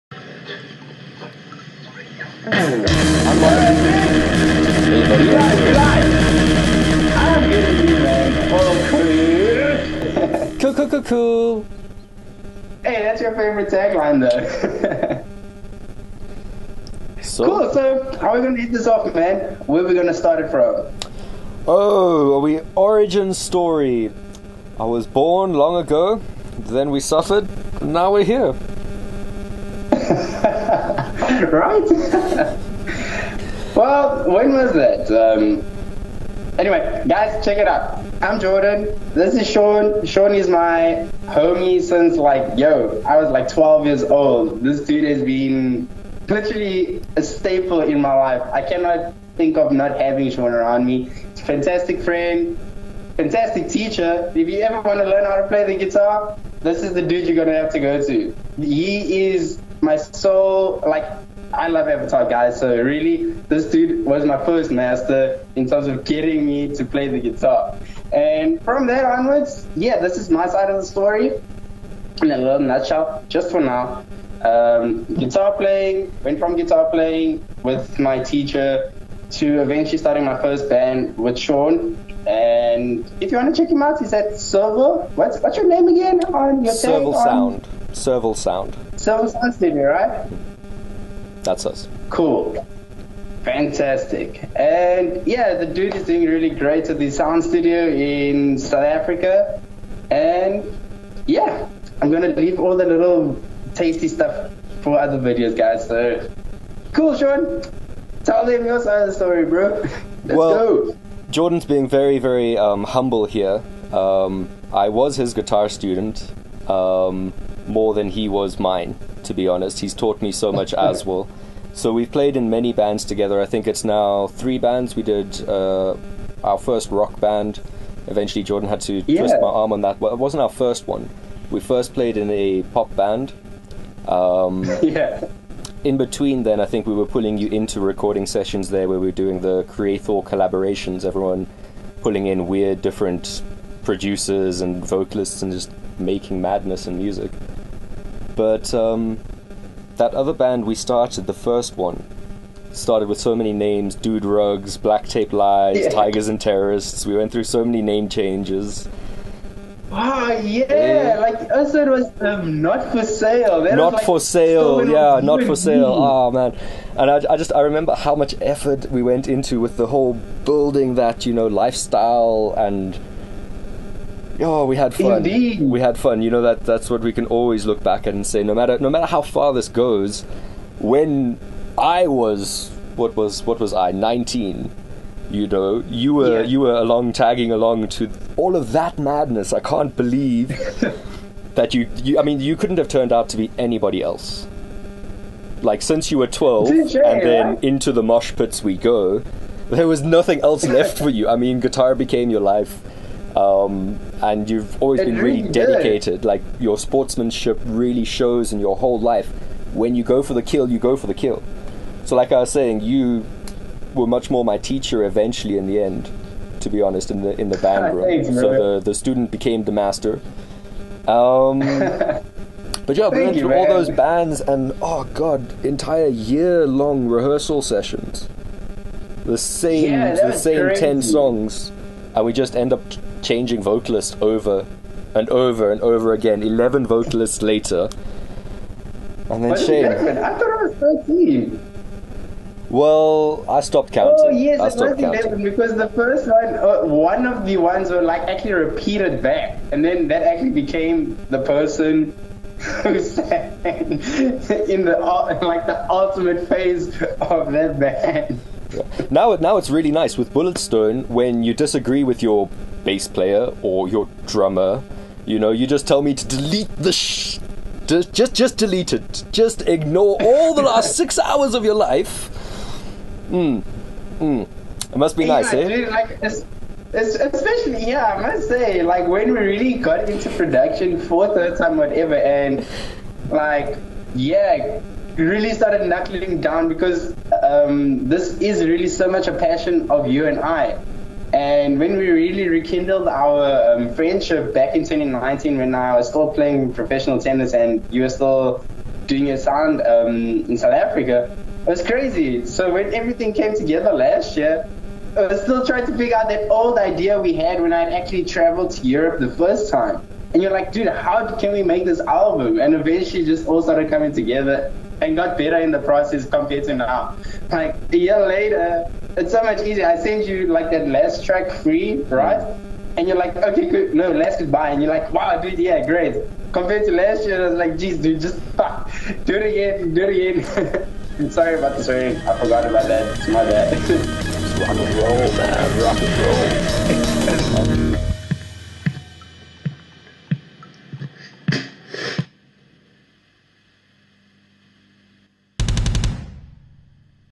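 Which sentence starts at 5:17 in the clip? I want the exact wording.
Like a year later, it's so much easier.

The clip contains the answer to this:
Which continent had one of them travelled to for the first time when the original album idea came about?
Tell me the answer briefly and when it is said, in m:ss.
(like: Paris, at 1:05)
Europe, at 5:08.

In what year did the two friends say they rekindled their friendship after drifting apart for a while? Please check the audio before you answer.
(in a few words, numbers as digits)
2019.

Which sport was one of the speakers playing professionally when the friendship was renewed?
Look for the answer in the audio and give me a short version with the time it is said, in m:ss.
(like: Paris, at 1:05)
Tennis, at 4:57.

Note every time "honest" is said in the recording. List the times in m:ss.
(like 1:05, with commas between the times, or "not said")
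1:59, 3:36.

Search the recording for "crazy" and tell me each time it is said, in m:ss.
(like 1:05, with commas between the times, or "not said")
3:50, 5:01.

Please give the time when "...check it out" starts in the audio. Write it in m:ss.
0:37.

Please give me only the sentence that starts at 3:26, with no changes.
Like your sportsmanship really shows in your whole life.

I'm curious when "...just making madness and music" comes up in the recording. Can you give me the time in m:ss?
2:25.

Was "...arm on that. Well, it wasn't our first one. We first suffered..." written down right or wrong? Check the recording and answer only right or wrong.
wrong.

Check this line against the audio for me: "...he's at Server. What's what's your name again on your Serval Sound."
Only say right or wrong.
right.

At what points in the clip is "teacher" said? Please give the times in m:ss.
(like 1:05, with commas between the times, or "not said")
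0:53, 1:18, 3:34.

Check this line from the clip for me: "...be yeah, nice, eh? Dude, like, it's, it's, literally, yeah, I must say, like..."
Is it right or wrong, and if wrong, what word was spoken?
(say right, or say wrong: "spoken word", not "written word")
wrong: "especially", not "literally".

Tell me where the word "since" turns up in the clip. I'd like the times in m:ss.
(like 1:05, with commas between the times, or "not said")
0:41, 3:15.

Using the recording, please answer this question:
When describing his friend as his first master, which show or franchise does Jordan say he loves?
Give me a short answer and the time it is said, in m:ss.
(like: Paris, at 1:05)
Avatar, at 1:01.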